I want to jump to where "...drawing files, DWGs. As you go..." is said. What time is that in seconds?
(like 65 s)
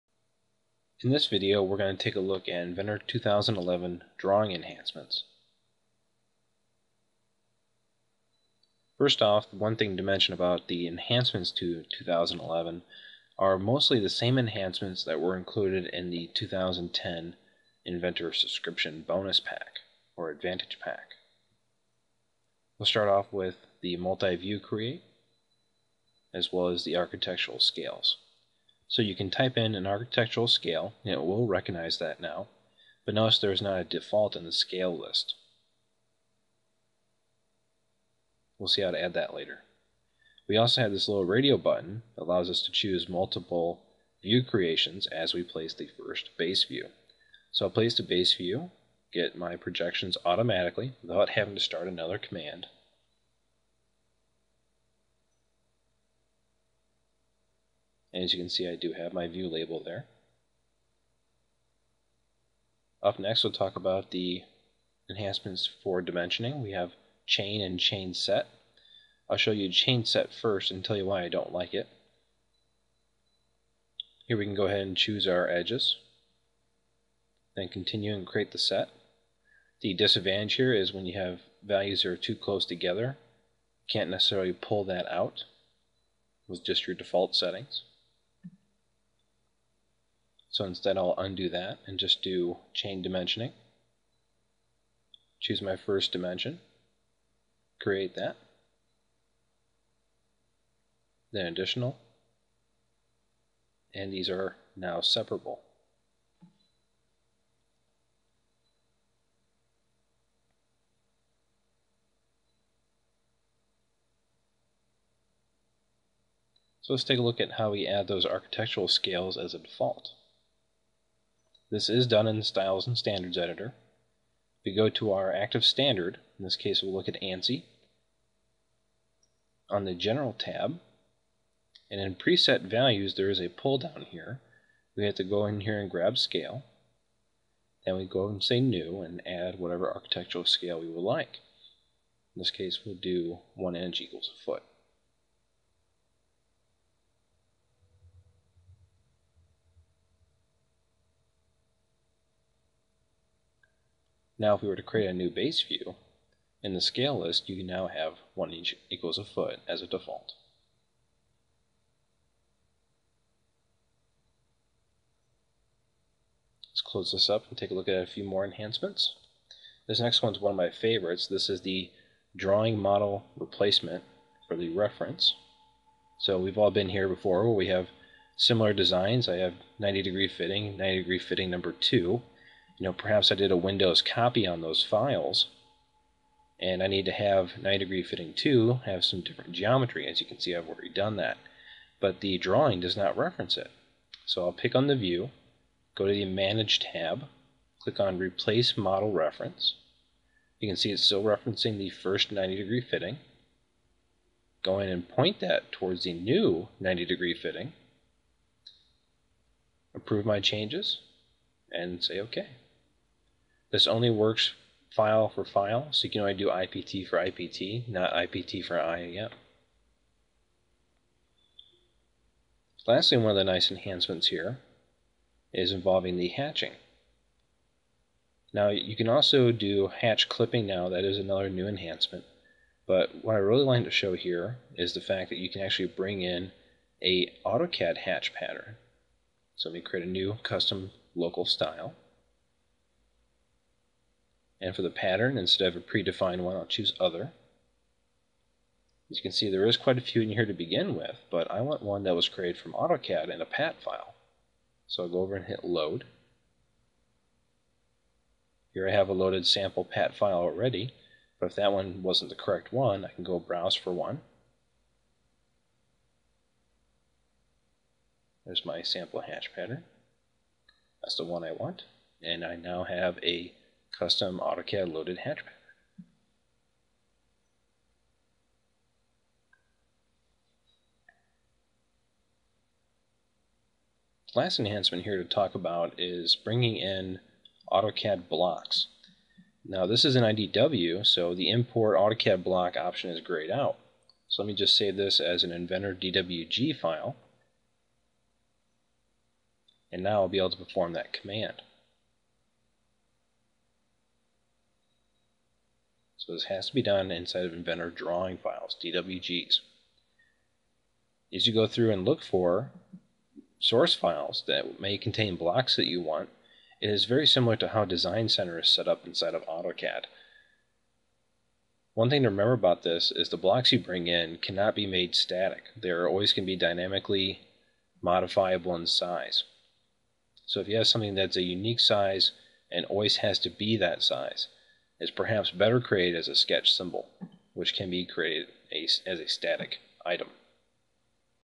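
307 s.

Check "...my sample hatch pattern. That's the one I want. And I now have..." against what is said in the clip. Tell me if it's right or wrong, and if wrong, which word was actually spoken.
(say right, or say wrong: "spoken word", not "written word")
right.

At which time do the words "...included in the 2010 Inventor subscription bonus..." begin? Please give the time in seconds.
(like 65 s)
15 s.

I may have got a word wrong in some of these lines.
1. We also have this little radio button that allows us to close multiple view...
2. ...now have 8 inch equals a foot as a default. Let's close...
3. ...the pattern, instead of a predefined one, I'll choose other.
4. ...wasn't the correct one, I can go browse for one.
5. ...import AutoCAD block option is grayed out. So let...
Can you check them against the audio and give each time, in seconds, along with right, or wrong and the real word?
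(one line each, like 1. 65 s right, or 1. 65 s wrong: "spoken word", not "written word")
1. 40 s wrong: "choose", not "close"
2. 157 s wrong: "1", not "8"
3. 244 s right
4. 262 s right
5. 291 s right.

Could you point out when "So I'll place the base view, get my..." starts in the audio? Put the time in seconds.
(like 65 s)
47 s.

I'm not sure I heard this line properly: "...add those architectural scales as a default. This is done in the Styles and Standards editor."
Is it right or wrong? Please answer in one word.
right.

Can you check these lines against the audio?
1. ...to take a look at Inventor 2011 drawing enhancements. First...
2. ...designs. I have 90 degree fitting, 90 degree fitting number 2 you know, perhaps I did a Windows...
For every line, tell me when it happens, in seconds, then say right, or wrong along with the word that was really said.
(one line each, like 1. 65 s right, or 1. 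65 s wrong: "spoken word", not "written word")
1. 1 s right
2. 178 s right.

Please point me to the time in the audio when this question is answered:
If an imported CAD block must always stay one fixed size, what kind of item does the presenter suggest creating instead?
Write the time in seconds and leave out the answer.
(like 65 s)
336 s.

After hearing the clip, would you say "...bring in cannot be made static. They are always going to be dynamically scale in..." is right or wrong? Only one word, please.
wrong.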